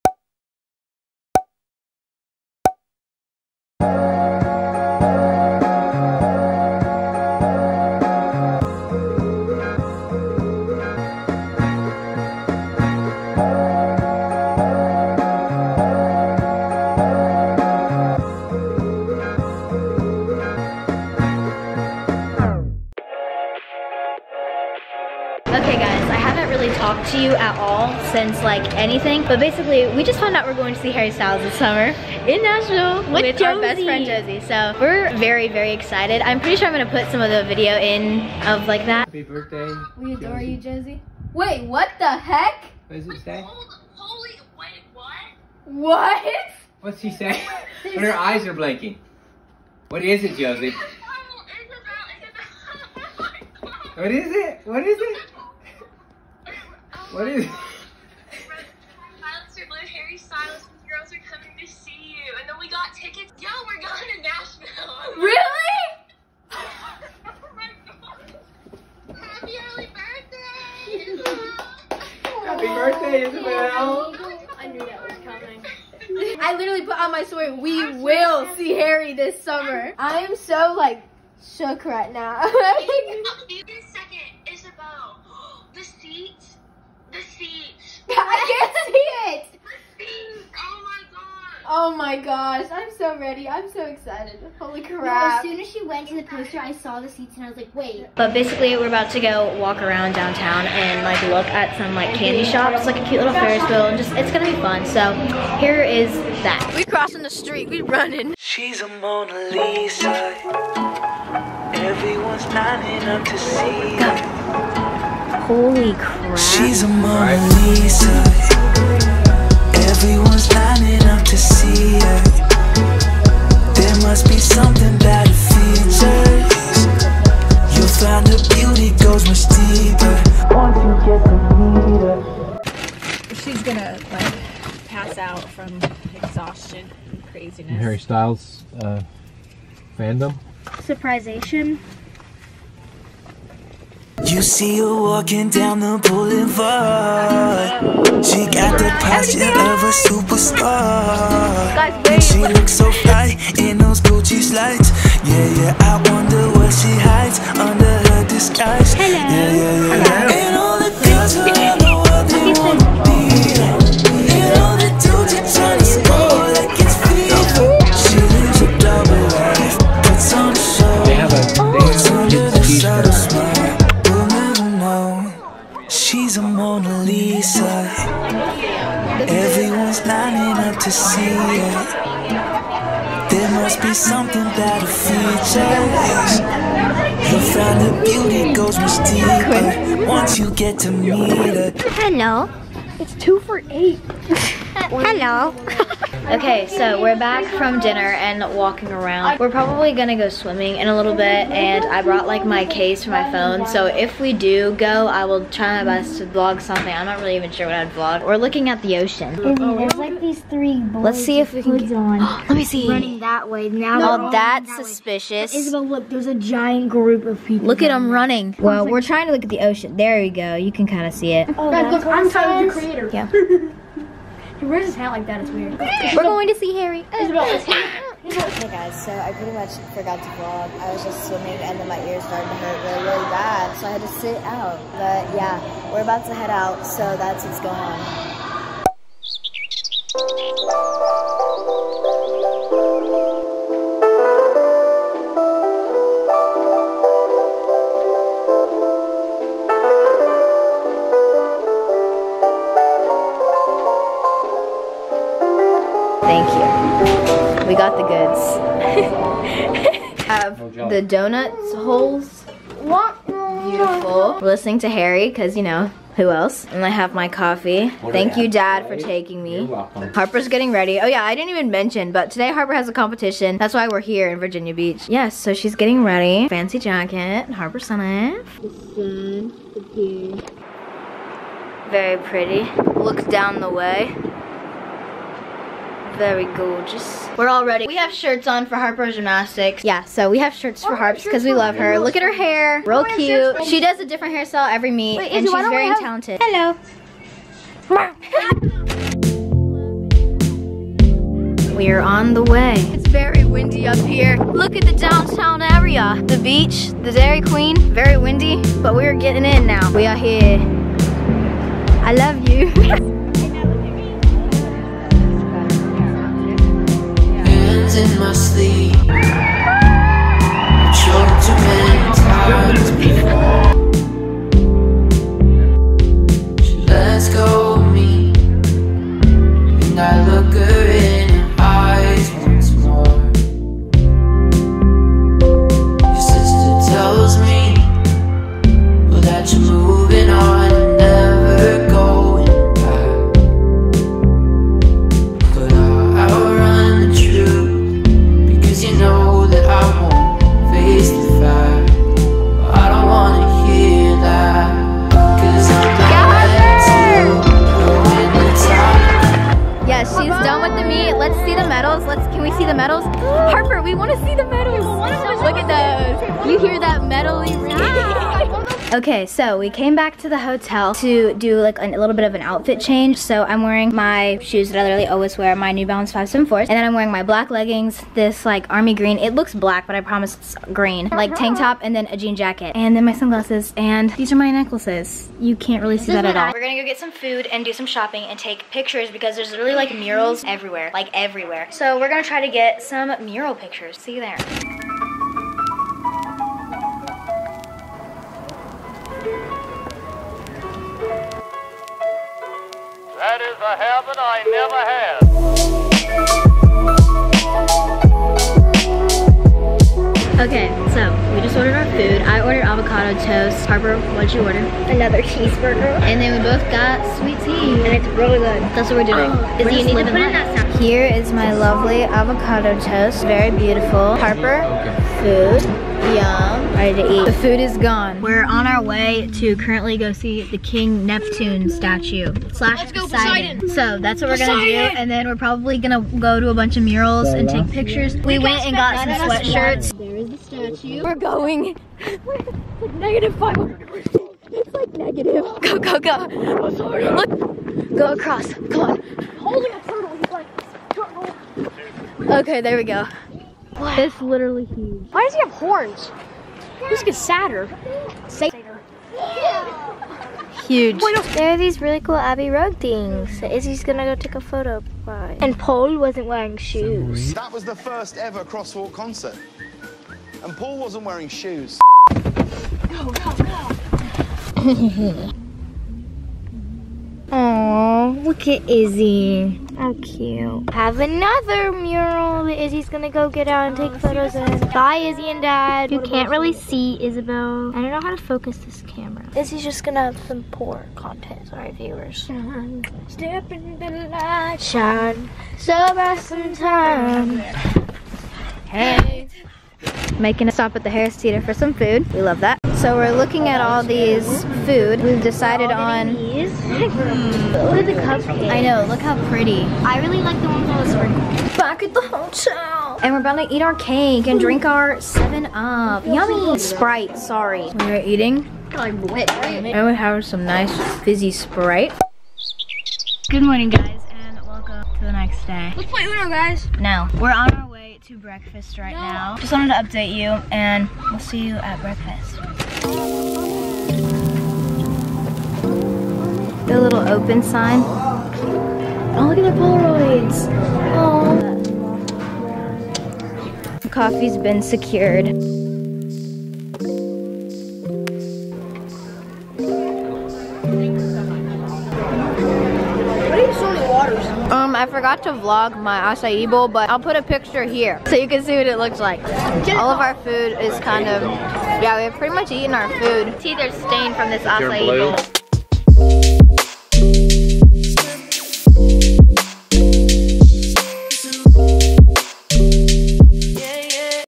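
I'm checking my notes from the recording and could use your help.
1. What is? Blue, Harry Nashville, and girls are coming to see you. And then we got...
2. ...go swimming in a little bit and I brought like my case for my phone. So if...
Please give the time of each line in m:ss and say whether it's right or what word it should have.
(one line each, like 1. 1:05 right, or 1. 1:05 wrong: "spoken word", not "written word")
1. 0:57 wrong: "Styles", not "Nashville"
2. 3:20 right.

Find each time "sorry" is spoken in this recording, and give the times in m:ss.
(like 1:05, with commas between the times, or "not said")
8:11, 8:37.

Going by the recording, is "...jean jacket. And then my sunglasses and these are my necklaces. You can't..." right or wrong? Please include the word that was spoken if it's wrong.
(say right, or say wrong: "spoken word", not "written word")
right.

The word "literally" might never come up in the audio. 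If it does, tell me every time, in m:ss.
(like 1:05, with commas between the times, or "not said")
1:16, 6:14, 7:34.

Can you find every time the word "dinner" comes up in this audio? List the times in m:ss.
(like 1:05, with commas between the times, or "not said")
3:17.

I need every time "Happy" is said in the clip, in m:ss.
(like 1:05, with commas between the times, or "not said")
0:39, 1:06, 1:12.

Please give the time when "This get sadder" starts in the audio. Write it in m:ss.
7:36.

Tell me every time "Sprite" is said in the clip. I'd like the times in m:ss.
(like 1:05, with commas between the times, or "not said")
8:36, 8:41.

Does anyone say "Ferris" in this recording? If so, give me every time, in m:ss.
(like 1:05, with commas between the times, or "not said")
1:43.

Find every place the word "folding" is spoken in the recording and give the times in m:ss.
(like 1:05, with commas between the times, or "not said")
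not said.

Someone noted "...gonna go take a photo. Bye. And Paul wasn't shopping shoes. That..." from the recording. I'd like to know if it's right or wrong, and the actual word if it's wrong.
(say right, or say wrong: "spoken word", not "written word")
wrong: "wearing", not "shopping".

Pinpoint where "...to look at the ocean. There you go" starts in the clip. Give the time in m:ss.
3:39.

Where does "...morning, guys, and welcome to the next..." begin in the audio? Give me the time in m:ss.
8:43.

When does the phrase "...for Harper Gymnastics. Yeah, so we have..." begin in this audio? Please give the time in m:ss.
4:48.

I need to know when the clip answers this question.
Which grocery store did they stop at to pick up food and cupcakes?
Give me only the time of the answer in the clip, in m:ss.
8:20.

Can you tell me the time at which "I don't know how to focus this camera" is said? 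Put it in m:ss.
8:07.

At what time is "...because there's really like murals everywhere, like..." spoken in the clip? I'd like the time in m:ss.
6:29.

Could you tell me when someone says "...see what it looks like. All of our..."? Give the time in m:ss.
9:18.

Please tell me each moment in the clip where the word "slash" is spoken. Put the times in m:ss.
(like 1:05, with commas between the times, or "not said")
7:12.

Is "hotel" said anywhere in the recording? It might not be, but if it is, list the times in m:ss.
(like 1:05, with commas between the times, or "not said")
6:10, 8:32.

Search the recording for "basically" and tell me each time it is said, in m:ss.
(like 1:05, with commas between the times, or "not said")
0:29, 1:38.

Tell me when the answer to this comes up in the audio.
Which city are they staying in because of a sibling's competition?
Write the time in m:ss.
4:34.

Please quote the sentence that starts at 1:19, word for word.
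I am so like shook right now.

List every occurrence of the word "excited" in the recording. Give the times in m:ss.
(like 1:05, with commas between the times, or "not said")
0:35, 1:33.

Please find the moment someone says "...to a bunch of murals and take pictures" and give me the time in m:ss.
7:16.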